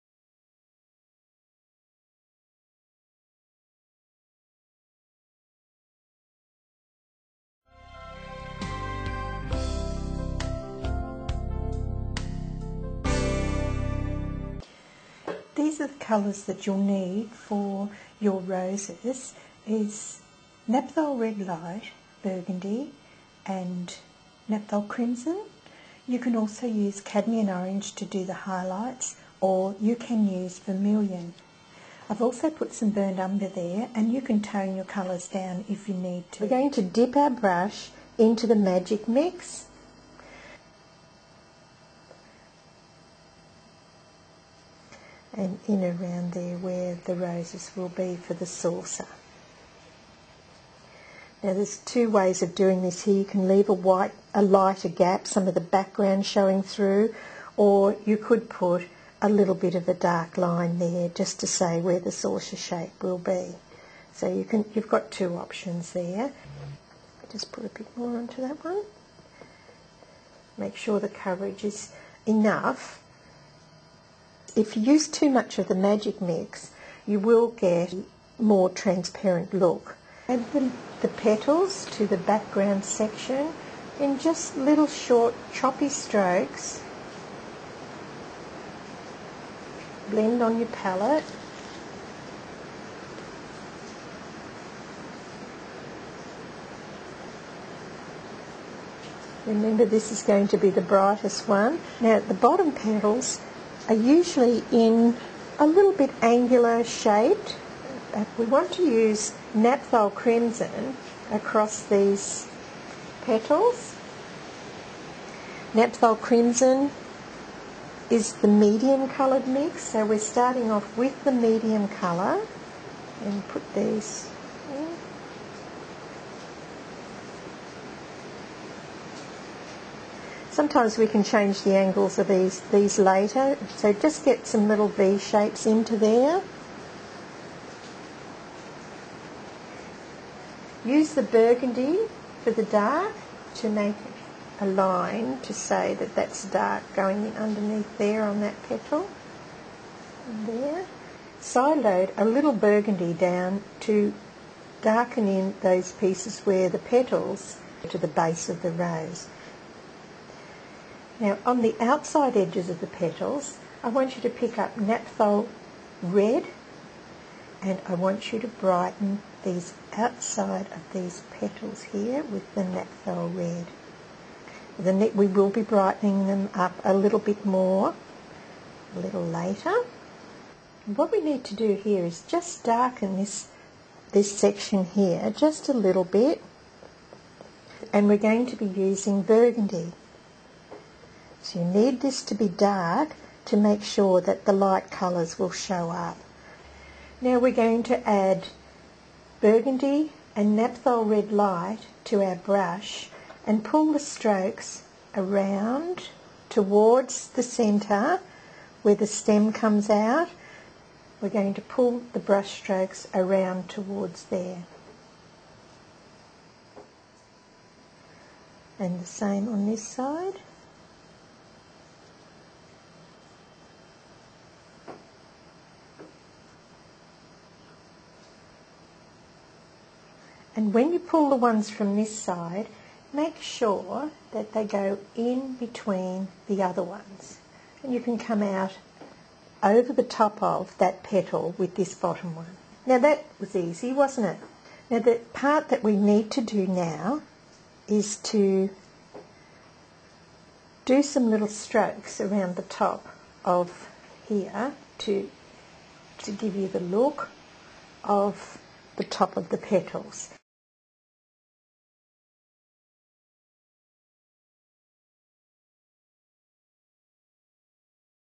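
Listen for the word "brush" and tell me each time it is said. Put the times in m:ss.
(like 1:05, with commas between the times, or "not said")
0:37, 3:22, 3:32.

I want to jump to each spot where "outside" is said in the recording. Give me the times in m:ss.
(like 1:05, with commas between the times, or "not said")
2:41, 2:49.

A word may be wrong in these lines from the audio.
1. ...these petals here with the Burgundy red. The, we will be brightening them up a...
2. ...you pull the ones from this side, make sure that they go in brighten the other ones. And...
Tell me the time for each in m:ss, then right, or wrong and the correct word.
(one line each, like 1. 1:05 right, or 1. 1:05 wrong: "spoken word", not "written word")
1. 2:50 wrong: "Naphthol", not "Burgundy"
2. 3:50 wrong: "between", not "brighten".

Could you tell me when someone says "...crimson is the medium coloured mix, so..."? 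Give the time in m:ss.
1:56.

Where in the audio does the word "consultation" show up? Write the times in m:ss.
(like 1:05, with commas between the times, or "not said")
not said.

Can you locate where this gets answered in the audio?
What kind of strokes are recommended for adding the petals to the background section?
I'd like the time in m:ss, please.
1:24.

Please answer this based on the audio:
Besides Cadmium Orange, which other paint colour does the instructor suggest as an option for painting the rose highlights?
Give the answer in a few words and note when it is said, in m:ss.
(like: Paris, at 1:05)
Vermilion, at 0:30.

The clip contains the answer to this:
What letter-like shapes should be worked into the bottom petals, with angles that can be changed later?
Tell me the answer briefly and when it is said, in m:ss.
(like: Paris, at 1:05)
V shapes, at 2:14.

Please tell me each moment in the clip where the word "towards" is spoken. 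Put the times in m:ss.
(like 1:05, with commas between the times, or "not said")
3:26, 3:33.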